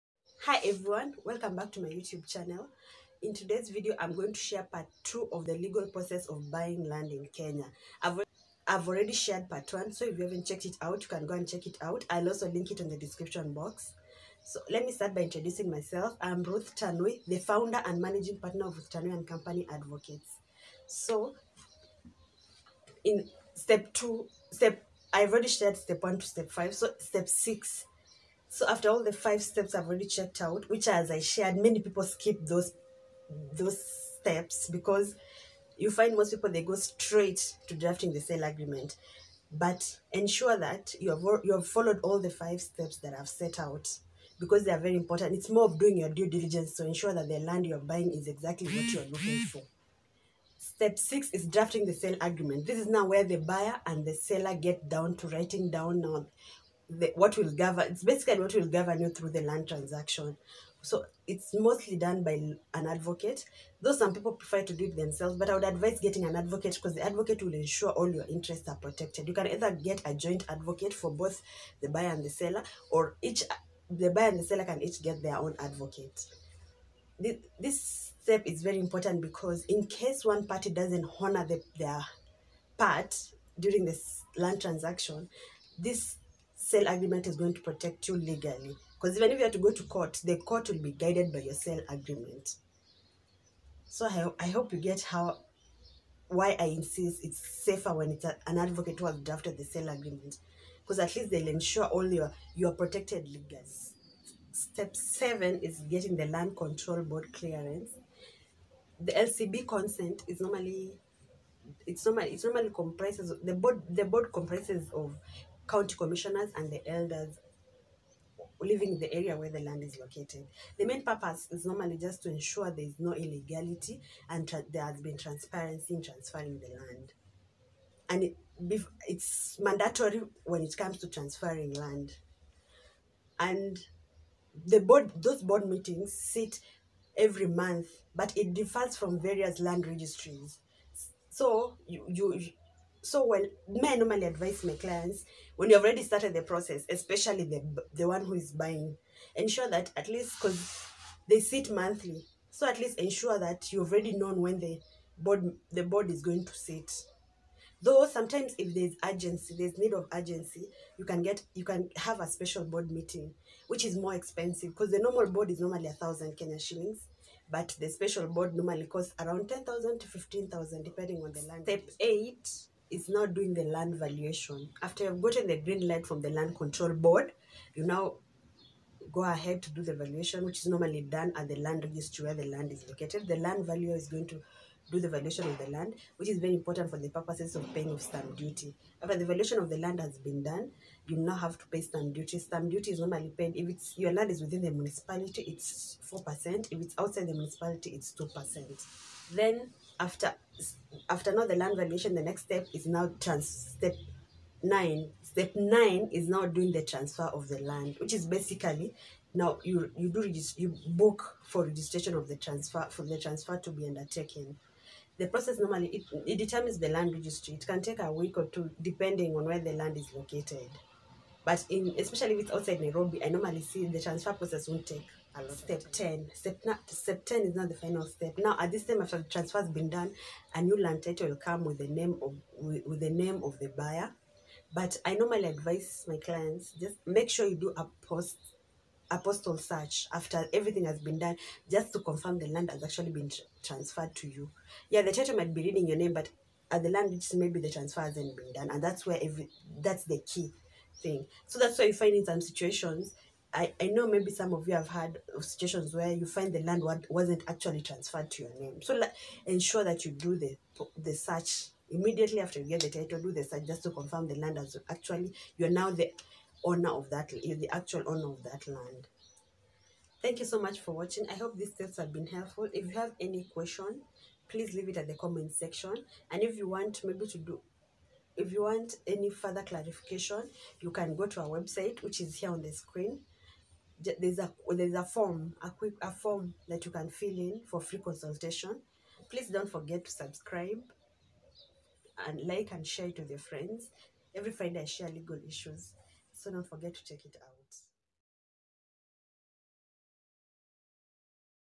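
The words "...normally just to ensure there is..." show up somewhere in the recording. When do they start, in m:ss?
2:01.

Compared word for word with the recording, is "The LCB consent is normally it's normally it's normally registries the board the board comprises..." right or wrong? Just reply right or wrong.
wrong.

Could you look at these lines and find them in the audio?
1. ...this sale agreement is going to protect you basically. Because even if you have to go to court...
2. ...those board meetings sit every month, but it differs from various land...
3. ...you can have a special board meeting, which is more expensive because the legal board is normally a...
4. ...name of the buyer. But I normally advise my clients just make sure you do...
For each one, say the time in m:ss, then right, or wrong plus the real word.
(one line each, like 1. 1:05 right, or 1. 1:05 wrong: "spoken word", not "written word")
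1. 1:25 wrong: "legally", not "basically"
2. 2:15 right
3. 2:41 wrong: "normal", not "legal"
4. 3:53 right.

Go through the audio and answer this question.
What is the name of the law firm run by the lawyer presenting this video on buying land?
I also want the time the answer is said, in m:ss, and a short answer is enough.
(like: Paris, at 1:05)
Ruth Tanui and Company Advocates, at 0:18.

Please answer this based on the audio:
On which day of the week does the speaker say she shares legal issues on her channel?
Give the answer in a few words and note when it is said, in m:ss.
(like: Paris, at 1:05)
Friday, at 4:54.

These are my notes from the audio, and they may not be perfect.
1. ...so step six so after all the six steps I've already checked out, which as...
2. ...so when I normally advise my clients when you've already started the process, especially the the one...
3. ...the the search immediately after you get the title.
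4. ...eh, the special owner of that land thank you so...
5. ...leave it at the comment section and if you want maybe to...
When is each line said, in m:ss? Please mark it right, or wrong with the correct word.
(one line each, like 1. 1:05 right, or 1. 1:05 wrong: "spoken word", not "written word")
1. 0:26 wrong: "five", not "six"
2. 2:23 right
3. 4:20 right
4. 4:27 wrong: "actual", not "special"
5. 4:34 right.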